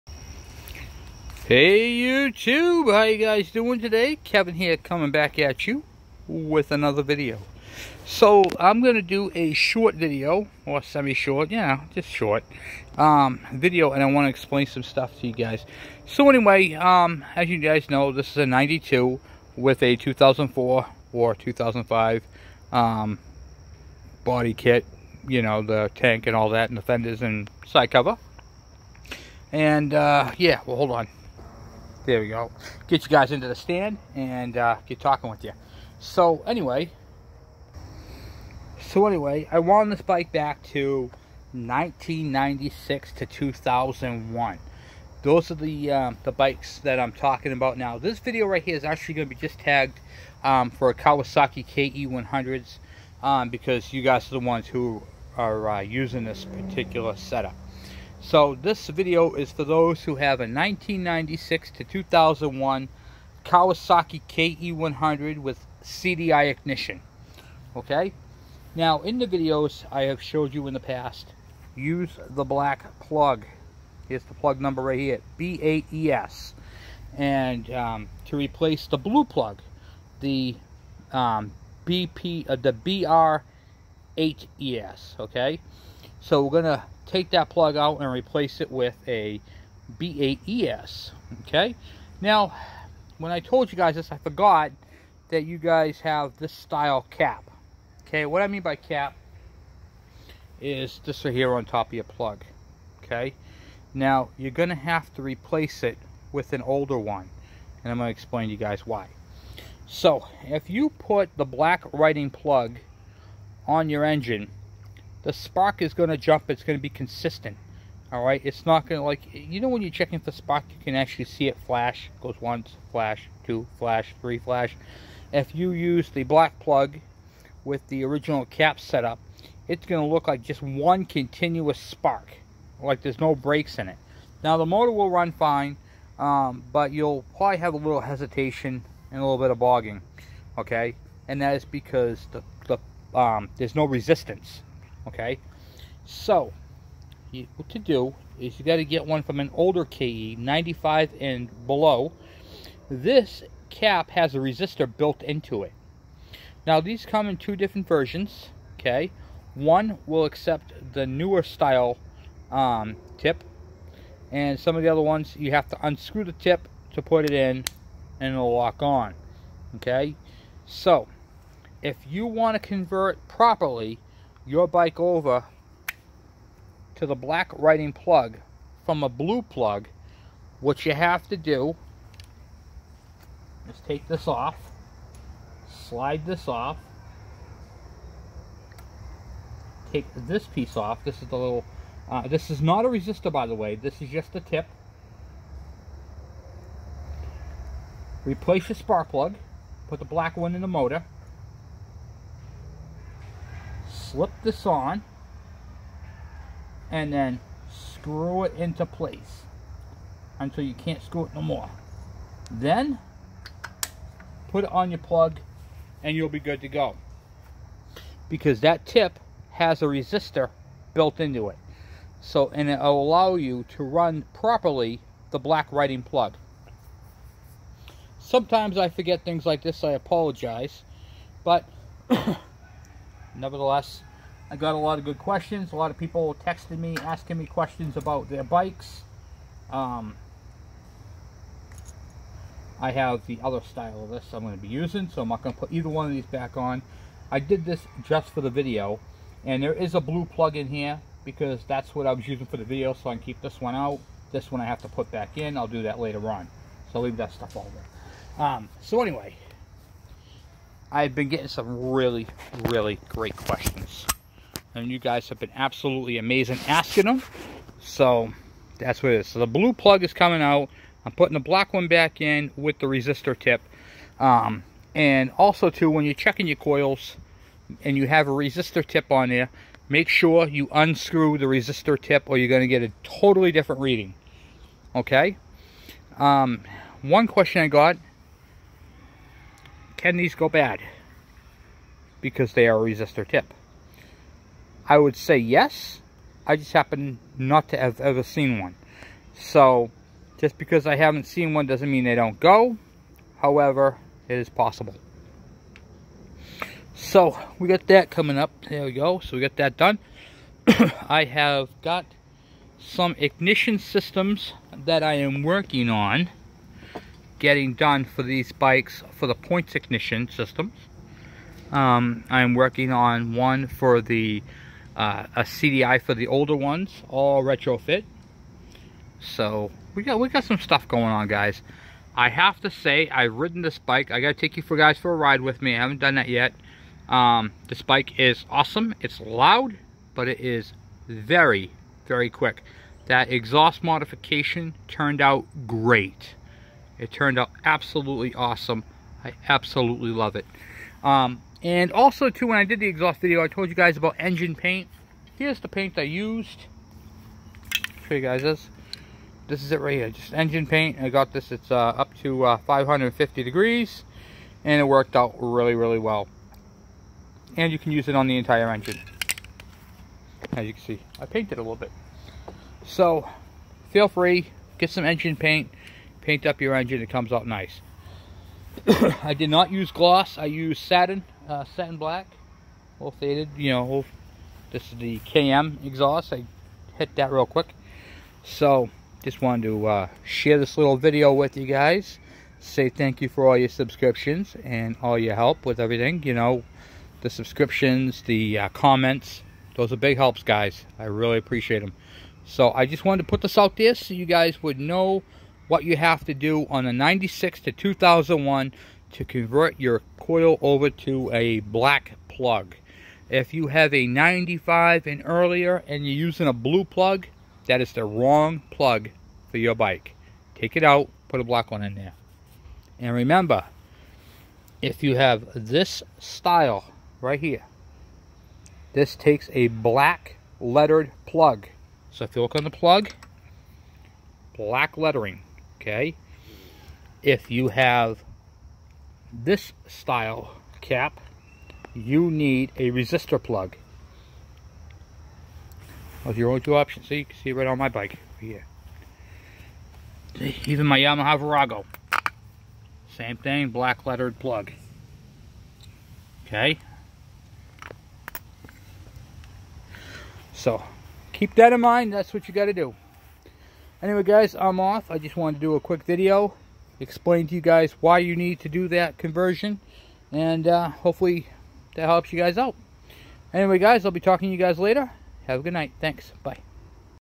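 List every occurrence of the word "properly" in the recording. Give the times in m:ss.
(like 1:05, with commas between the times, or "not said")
2:53, 3:44.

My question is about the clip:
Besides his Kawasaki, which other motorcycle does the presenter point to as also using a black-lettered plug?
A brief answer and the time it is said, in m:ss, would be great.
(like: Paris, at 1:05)
Yamaha Virago, at 7:30.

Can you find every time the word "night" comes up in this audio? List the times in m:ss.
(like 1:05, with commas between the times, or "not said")
7:55.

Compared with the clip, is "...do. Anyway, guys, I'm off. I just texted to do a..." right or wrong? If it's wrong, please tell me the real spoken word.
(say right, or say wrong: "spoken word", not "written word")
wrong: "wanted", not "texted".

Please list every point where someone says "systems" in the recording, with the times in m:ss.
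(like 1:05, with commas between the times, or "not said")
5:13, 5:20.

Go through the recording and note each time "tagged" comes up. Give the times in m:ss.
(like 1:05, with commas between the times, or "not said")
0:49.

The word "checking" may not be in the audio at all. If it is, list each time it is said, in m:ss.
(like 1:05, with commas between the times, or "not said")
1:59, 4:36.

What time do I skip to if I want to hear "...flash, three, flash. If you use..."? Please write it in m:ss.
2:03.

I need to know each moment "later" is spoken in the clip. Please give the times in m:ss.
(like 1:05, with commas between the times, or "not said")
4:15, 7:54.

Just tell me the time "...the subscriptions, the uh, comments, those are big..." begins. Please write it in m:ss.
6:37.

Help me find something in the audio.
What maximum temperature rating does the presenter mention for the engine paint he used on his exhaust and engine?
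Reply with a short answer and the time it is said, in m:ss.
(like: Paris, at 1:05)
550 degrees, at 6:02.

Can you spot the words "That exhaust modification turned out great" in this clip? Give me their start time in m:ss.
5:43.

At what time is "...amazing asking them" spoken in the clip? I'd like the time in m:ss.
4:26.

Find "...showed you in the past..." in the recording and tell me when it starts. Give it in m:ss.
1:10.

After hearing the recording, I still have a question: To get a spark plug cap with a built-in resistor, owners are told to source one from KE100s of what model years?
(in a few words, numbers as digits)
95 and below.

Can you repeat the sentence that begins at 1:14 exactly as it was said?
Here's the plug number right here, B8ES.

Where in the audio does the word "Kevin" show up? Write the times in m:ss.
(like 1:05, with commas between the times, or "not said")
0:04.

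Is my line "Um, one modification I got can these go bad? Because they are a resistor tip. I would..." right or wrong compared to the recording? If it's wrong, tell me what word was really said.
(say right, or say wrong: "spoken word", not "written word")
wrong: "question", not "modification".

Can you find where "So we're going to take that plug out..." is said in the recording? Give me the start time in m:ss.
1:26.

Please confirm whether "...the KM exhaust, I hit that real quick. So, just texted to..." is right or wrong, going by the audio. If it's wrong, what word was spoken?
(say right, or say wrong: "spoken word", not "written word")
wrong: "wanted", not "texted".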